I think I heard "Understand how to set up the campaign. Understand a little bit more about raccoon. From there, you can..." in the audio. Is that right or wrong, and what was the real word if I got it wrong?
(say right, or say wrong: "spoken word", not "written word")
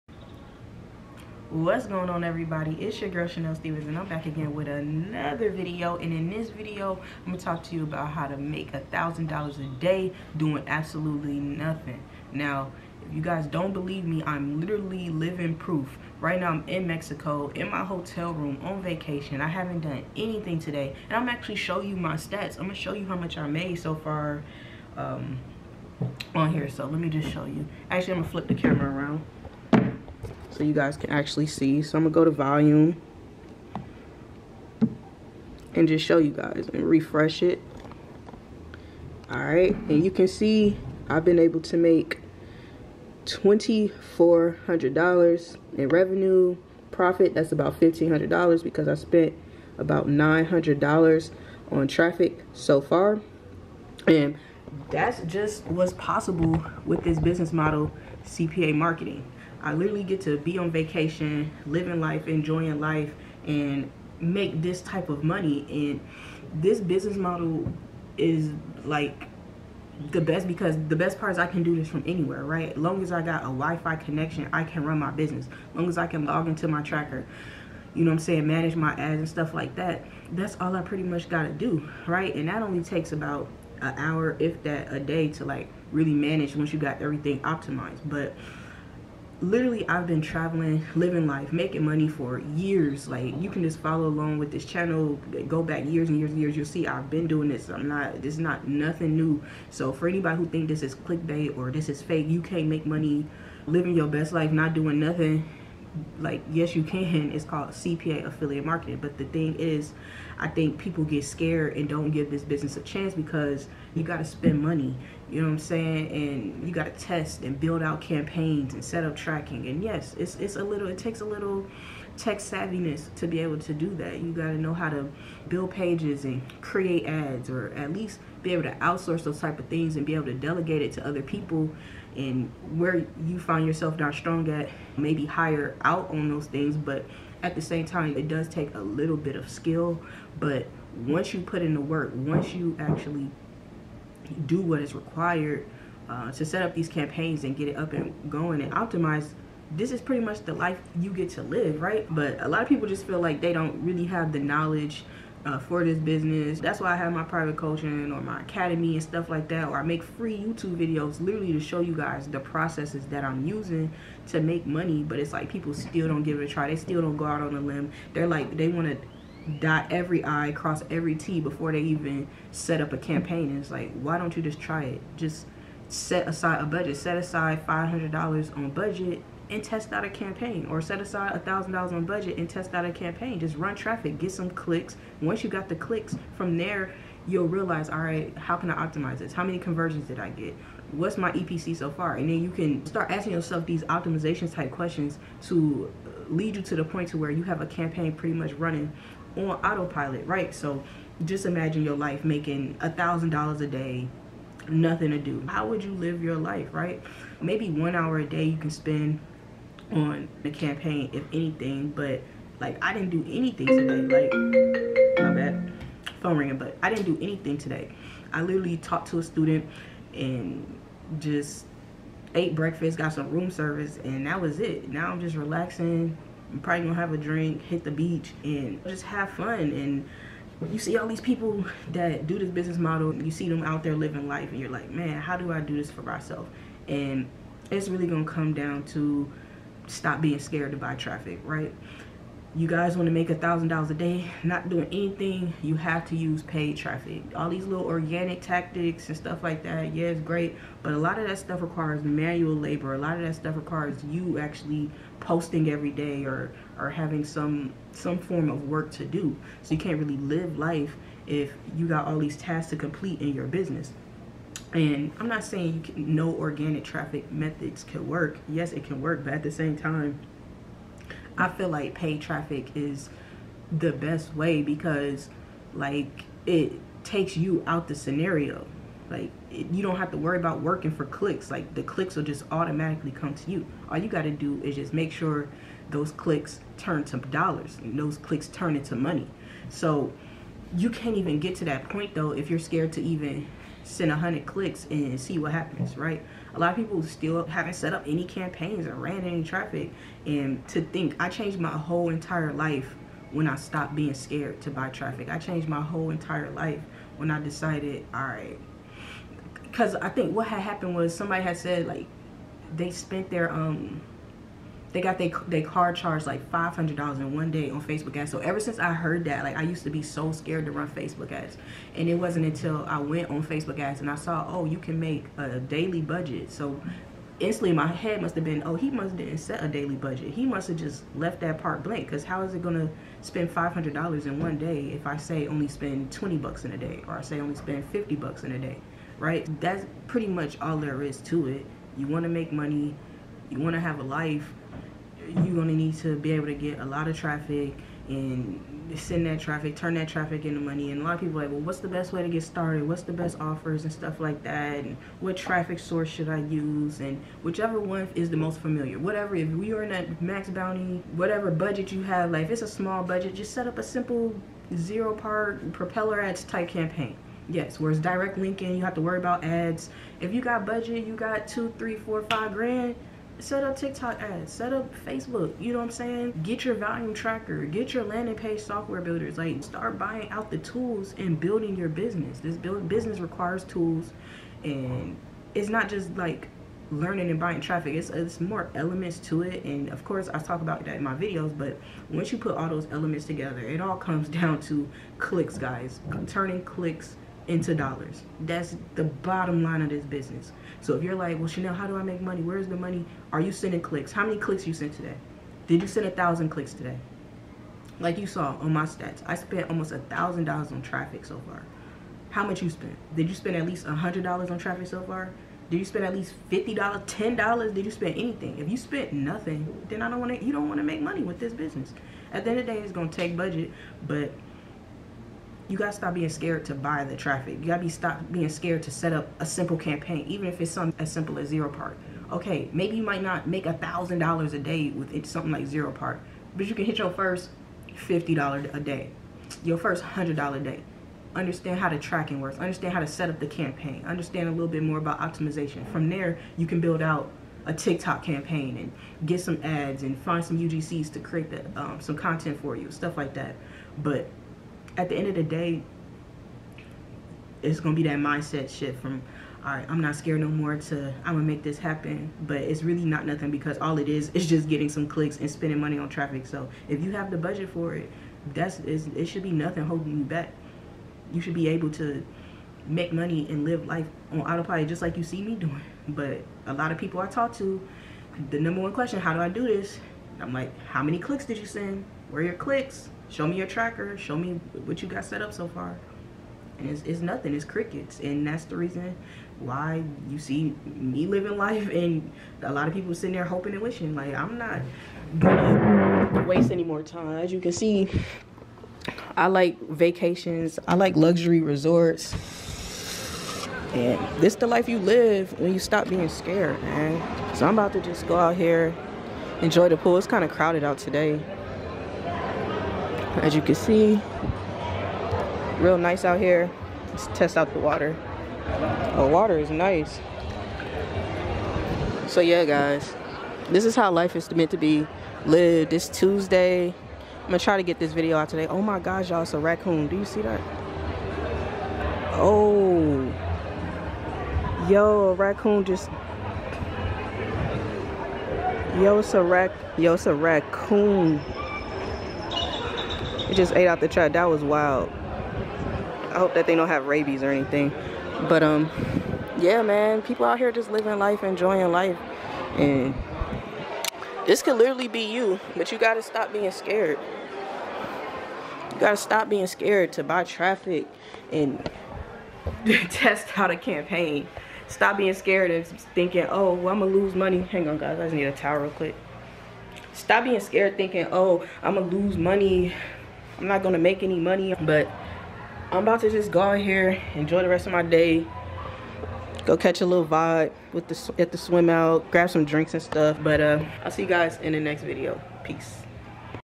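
wrong: "optimization", not "raccoon".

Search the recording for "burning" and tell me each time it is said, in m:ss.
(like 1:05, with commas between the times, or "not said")
not said.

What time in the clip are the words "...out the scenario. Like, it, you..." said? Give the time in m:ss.
4:37.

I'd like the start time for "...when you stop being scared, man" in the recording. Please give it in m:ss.
8:25.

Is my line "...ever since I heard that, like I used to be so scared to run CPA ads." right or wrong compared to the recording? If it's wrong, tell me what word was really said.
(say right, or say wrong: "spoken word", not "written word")
wrong: "Facebook", not "CPA".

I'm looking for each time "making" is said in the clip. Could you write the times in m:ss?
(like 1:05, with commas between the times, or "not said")
1:31, 3:22.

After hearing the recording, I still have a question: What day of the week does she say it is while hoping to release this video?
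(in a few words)
Tuesday.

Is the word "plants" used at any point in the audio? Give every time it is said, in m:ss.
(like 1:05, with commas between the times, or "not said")
not said.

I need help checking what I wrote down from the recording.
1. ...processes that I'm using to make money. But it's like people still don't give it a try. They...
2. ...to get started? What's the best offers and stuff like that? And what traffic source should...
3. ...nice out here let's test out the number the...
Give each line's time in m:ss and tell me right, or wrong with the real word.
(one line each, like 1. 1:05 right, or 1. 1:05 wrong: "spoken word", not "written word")
1. 2:42 right
2. 5:52 right
3. 8:35 wrong: "water", not "number".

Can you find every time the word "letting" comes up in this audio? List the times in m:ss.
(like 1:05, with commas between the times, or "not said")
not said.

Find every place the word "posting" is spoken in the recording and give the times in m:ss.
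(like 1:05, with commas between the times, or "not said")
4:15.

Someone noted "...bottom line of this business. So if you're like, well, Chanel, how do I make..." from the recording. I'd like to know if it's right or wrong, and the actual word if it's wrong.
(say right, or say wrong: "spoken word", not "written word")
right.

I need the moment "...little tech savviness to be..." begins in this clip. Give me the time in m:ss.
2:01.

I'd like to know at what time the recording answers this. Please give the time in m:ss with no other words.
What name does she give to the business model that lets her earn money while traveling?
0:58.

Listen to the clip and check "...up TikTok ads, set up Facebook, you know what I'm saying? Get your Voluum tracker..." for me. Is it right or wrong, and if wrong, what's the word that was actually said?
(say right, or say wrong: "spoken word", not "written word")
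right.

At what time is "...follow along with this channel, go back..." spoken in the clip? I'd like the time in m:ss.
1:33.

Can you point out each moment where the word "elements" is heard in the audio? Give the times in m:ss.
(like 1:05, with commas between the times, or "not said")
6:28, 6:32.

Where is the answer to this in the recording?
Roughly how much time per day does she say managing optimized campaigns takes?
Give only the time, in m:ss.
1:23.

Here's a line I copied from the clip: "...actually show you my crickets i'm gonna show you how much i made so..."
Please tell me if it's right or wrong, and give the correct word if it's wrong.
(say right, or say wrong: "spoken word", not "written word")
wrong: "stats", not "crickets".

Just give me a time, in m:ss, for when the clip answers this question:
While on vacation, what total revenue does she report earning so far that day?
0:43.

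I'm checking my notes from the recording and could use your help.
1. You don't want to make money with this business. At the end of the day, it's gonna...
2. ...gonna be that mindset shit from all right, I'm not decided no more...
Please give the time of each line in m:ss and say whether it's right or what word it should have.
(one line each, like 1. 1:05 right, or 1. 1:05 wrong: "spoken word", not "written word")
1. 7:00 right
2. 7:37 wrong: "scared", not "decided".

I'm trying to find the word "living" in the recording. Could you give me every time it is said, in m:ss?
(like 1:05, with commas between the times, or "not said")
0:15, 1:01, 1:30, 1:43, 3:53, 8:11, 9:10.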